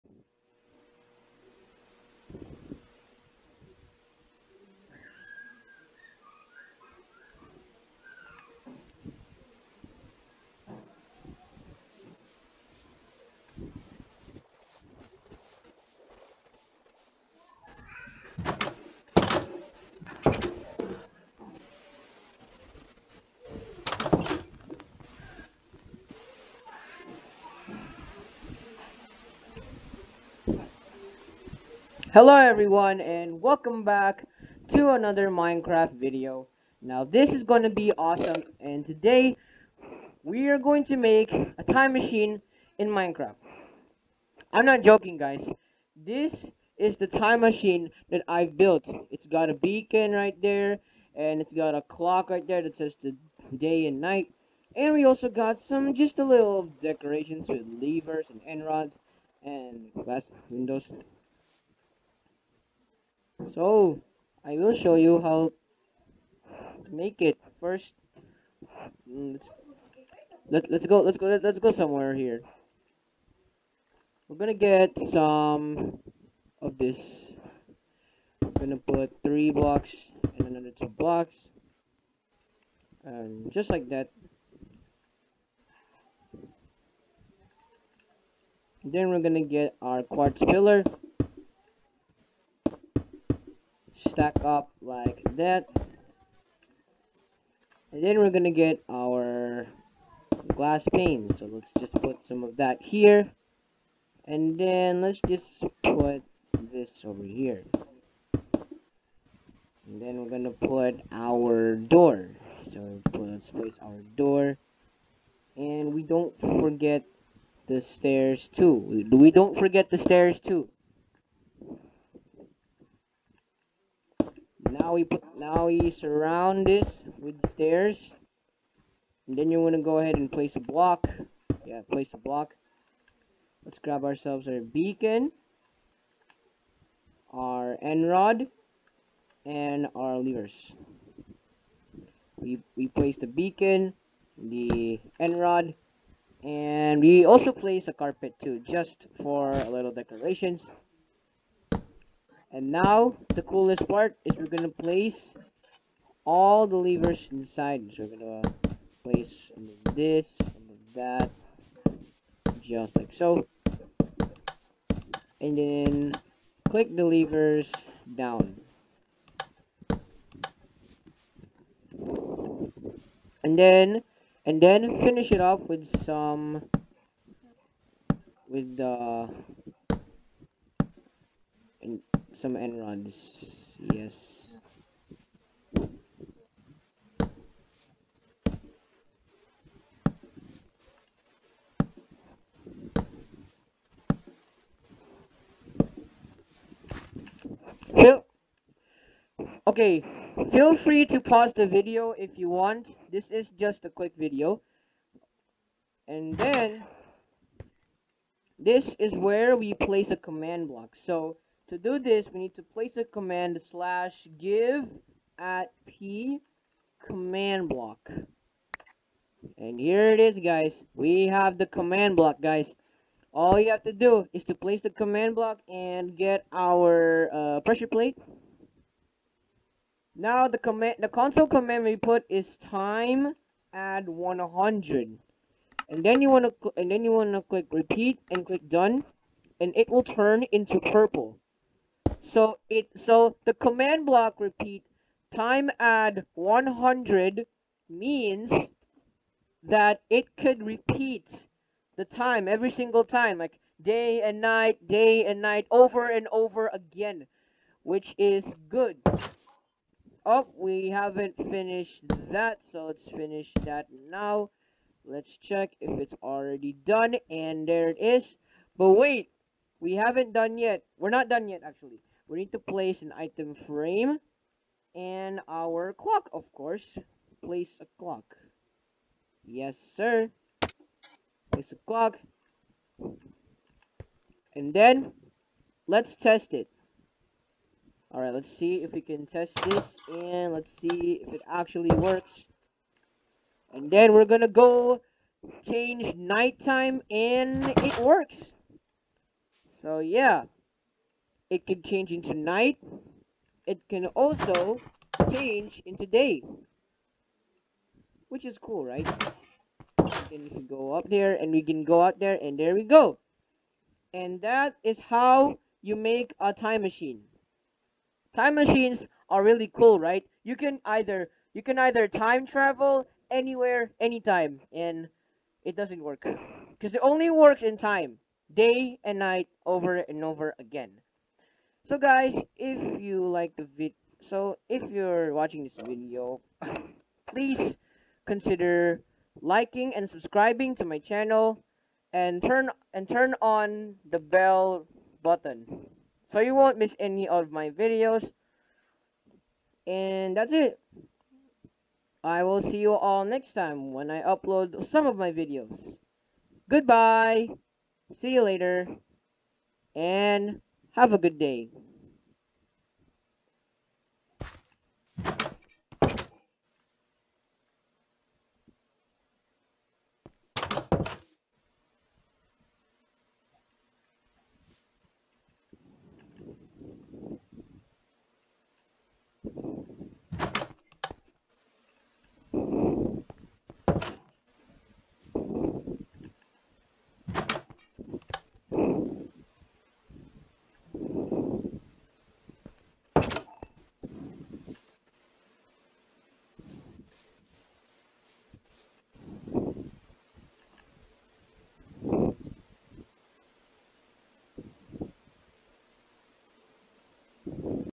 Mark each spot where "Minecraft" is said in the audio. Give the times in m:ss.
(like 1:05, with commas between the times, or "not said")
0:35, 0:42.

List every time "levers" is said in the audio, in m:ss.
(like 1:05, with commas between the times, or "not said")
0:57, 2:20, 2:36, 2:47.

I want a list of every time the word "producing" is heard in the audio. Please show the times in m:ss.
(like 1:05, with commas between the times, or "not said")
not said.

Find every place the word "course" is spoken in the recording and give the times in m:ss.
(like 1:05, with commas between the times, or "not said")
4:36.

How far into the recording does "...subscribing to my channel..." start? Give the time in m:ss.
5:40.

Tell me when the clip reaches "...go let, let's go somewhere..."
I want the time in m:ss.
1:11.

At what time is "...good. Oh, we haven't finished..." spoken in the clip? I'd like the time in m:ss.
4:18.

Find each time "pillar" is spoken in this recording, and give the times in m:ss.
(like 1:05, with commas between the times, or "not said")
1:30.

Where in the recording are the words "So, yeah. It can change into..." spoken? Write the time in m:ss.
4:59.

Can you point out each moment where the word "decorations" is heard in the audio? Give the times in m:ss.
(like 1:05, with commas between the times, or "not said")
0:56, 2:29.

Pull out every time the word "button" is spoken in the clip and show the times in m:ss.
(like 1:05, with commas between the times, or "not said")
5:45.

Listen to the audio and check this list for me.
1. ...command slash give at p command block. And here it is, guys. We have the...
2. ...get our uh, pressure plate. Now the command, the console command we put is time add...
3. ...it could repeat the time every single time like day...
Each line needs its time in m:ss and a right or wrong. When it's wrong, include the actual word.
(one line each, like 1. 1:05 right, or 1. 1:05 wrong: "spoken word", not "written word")
1. 3:33 right
2. 3:46 right
3. 4:10 right.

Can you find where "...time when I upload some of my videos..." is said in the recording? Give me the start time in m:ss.
5:53.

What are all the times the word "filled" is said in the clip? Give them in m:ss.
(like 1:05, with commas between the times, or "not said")
not said.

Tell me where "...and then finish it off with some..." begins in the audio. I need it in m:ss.
2:54.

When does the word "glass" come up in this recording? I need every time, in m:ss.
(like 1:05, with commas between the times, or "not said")
1:00, 1:40.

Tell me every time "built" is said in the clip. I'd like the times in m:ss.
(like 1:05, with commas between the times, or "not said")
0:48.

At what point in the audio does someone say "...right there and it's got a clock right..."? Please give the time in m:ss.
0:50.